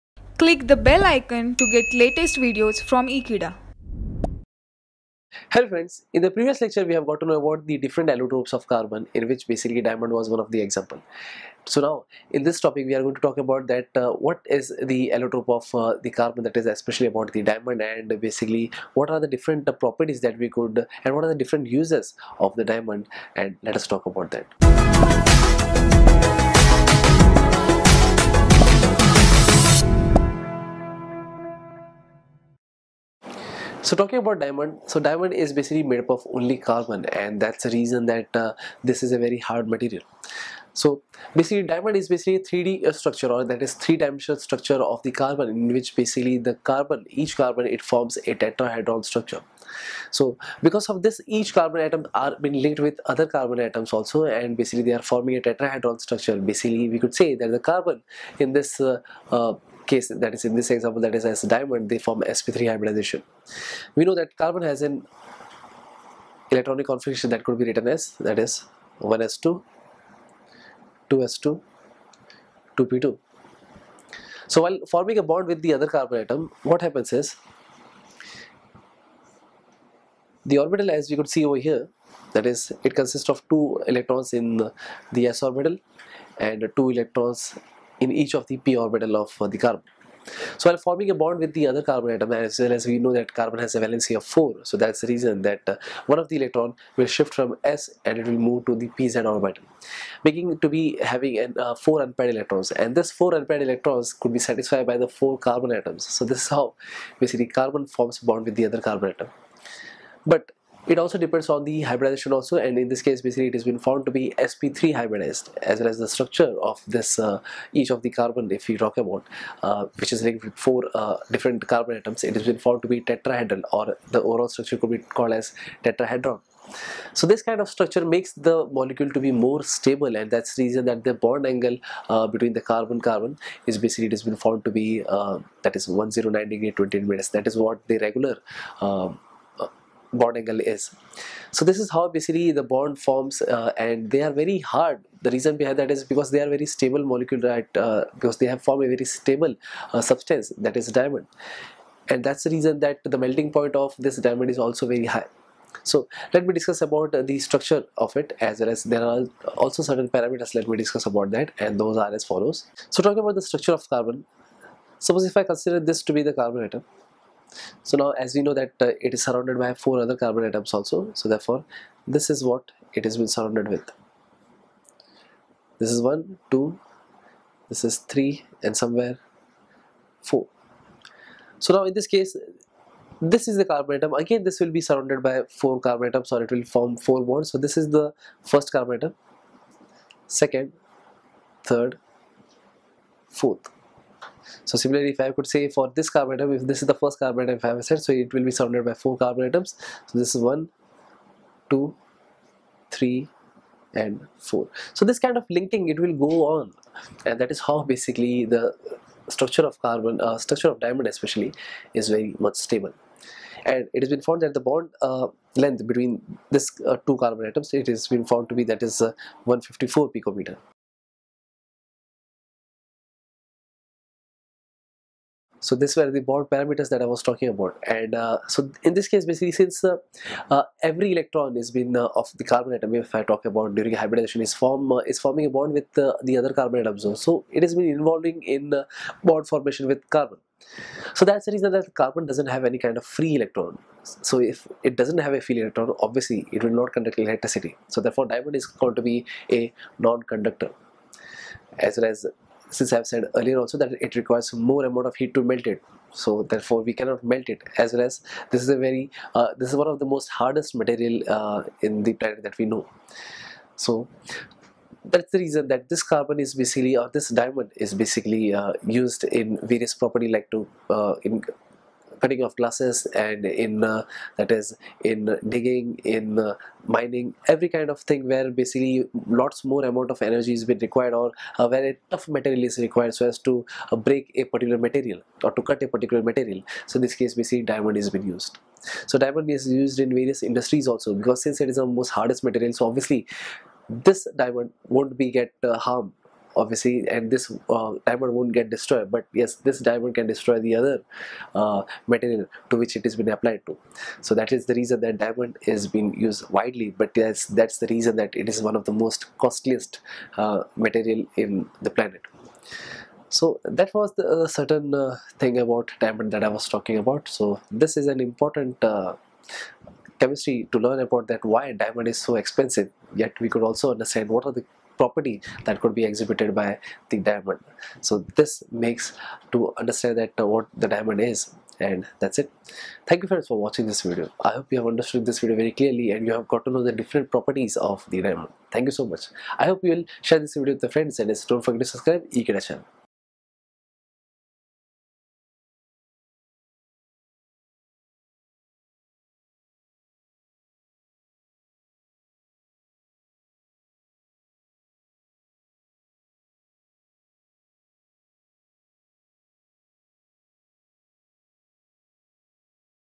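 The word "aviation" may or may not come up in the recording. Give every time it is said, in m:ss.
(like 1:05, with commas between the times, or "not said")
not said.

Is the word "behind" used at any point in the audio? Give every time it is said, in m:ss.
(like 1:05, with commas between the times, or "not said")
2:25.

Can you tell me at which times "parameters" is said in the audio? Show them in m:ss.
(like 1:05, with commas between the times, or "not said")
2:40, 3:46.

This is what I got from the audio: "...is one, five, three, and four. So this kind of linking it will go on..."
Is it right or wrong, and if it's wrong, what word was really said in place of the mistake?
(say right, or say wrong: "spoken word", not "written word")
wrong: "two", not "five".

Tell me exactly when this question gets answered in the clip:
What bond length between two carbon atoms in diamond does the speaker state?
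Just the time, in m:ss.
3:39.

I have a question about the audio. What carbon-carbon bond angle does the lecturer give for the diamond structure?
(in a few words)
109 degrees 20 minutes.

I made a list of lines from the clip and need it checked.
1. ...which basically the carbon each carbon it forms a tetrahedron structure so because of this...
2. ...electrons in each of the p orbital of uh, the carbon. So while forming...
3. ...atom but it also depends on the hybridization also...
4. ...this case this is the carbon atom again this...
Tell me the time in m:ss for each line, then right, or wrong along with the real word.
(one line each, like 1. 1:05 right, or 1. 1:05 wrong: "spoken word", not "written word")
1. 0:45 right
2. 1:26 right
3. 1:49 right
4. 3:01 right.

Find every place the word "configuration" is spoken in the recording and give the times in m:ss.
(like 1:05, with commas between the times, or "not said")
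1:06.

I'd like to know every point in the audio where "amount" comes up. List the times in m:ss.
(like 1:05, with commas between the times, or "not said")
4:14, 4:39.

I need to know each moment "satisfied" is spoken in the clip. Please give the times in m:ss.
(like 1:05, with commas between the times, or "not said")
1:44.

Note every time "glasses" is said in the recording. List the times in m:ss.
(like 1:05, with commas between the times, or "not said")
4:32.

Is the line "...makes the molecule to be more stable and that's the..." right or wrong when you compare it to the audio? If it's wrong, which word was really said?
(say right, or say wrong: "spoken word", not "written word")
right.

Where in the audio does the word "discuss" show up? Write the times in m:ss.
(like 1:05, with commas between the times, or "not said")
2:36, 2:40.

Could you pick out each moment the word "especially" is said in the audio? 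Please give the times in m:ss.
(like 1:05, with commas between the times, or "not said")
0:16, 3:31.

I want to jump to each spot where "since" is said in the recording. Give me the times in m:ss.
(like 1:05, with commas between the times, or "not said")
3:49, 4:12, 4:51.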